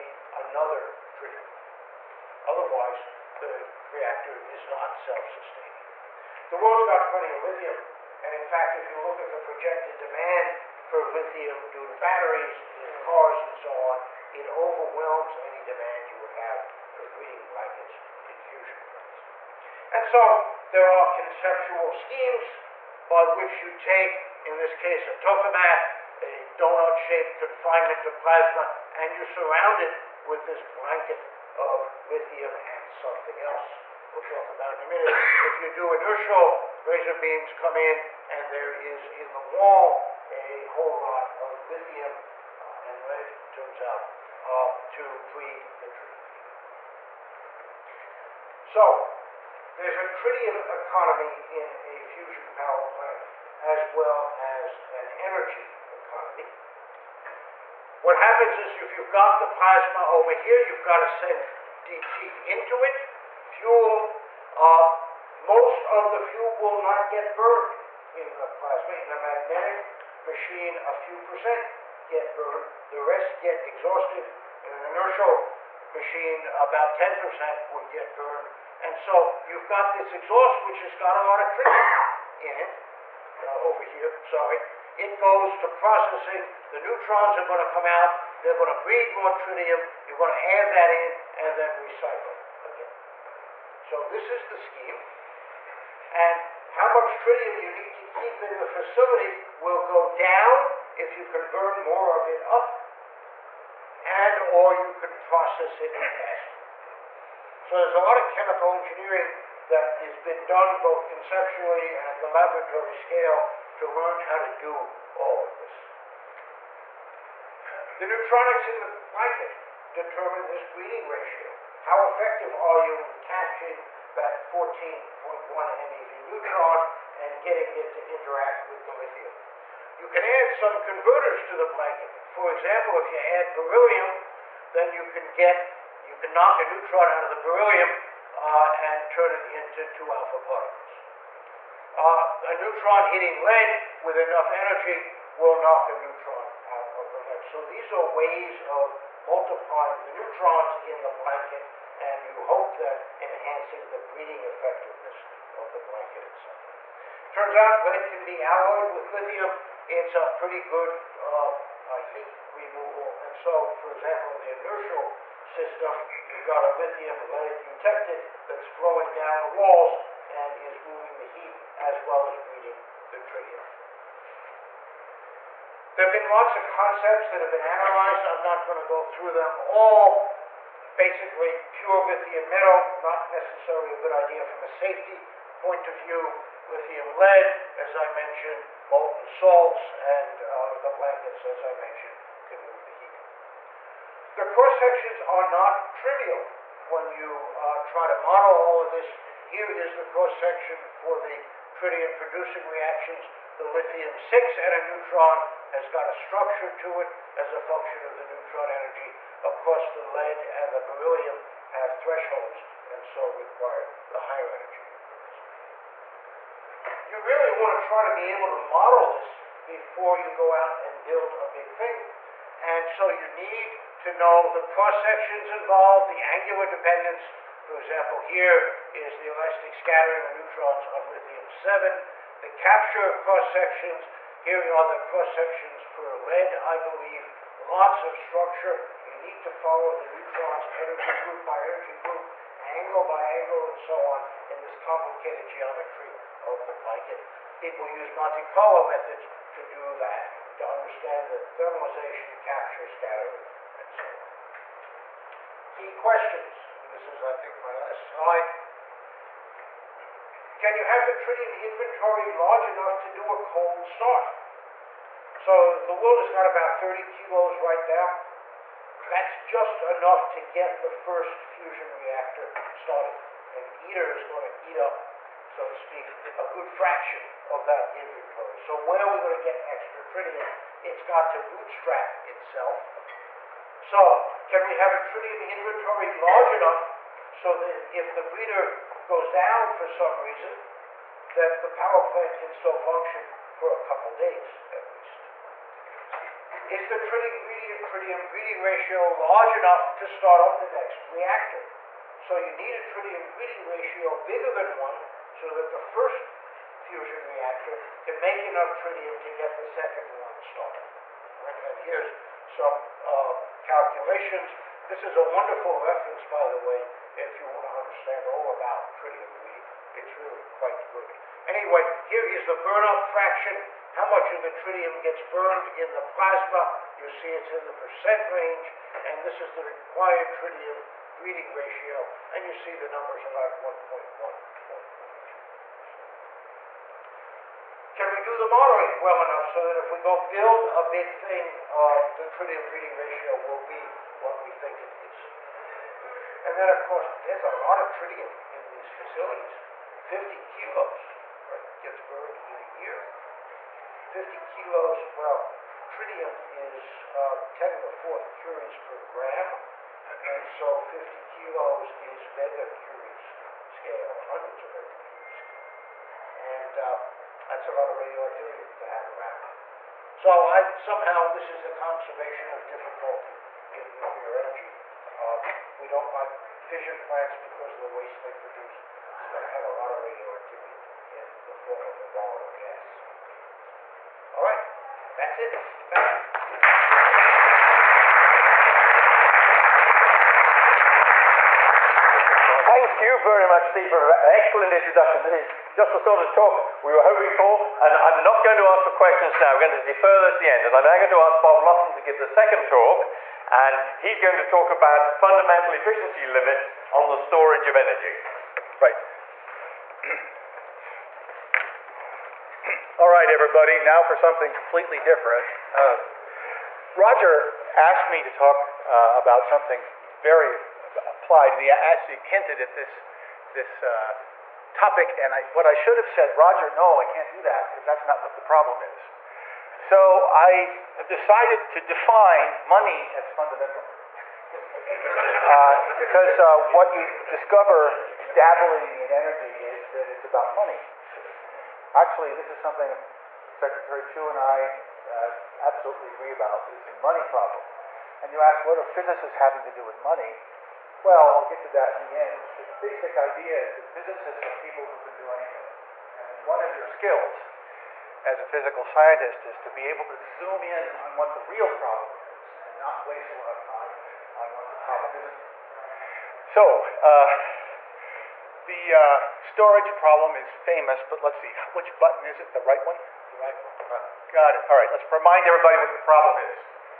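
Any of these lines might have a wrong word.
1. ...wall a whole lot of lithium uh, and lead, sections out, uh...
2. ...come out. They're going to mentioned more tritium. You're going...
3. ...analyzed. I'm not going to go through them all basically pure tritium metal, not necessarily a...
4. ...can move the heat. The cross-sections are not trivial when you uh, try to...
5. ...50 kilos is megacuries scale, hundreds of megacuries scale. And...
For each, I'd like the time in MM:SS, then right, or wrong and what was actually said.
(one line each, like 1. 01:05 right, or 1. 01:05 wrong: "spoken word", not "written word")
1. 00:39 wrong: "turns", not "sections"
2. 01:27 wrong: "breed", not "mentioned"
3. 02:57 wrong: "lithium", not "tritium"
4. 03:12 right
5. 06:00 right.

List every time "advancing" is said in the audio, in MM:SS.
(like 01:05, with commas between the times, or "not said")
not said.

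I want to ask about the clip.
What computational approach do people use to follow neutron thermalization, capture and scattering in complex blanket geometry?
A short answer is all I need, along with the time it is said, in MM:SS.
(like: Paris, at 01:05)
Monte Carlo methods, at 04:08.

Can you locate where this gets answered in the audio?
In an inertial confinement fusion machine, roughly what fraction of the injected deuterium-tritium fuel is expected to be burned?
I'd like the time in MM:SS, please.
01:16.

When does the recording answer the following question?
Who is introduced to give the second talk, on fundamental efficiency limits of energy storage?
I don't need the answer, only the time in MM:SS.
06:41.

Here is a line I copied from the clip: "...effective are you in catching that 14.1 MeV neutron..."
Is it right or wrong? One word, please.
right.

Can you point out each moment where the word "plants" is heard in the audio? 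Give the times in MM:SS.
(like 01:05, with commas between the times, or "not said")
00:18, 00:52, 04:52, 06:16.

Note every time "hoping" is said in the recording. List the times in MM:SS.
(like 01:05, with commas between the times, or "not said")
06:37.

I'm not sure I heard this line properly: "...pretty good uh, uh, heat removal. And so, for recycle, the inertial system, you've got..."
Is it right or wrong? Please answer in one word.
wrong.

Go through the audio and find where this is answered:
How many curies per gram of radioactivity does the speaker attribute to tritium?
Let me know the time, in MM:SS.
05:57.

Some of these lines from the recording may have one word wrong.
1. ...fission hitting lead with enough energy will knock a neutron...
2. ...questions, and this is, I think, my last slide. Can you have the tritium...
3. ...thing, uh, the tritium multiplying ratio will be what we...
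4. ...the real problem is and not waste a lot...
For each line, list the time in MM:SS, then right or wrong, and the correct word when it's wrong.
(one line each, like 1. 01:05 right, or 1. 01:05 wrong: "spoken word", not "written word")
1. 02:22 wrong: "neutron", not "fission"
2. 04:15 right
3. 05:41 wrong: "breeding", not "multiplying"
4. 07:41 right.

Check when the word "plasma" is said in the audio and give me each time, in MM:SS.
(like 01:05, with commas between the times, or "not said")
00:28, 00:59, 01:08, 05:26.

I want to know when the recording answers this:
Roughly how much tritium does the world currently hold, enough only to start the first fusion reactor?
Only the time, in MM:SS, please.
04:26.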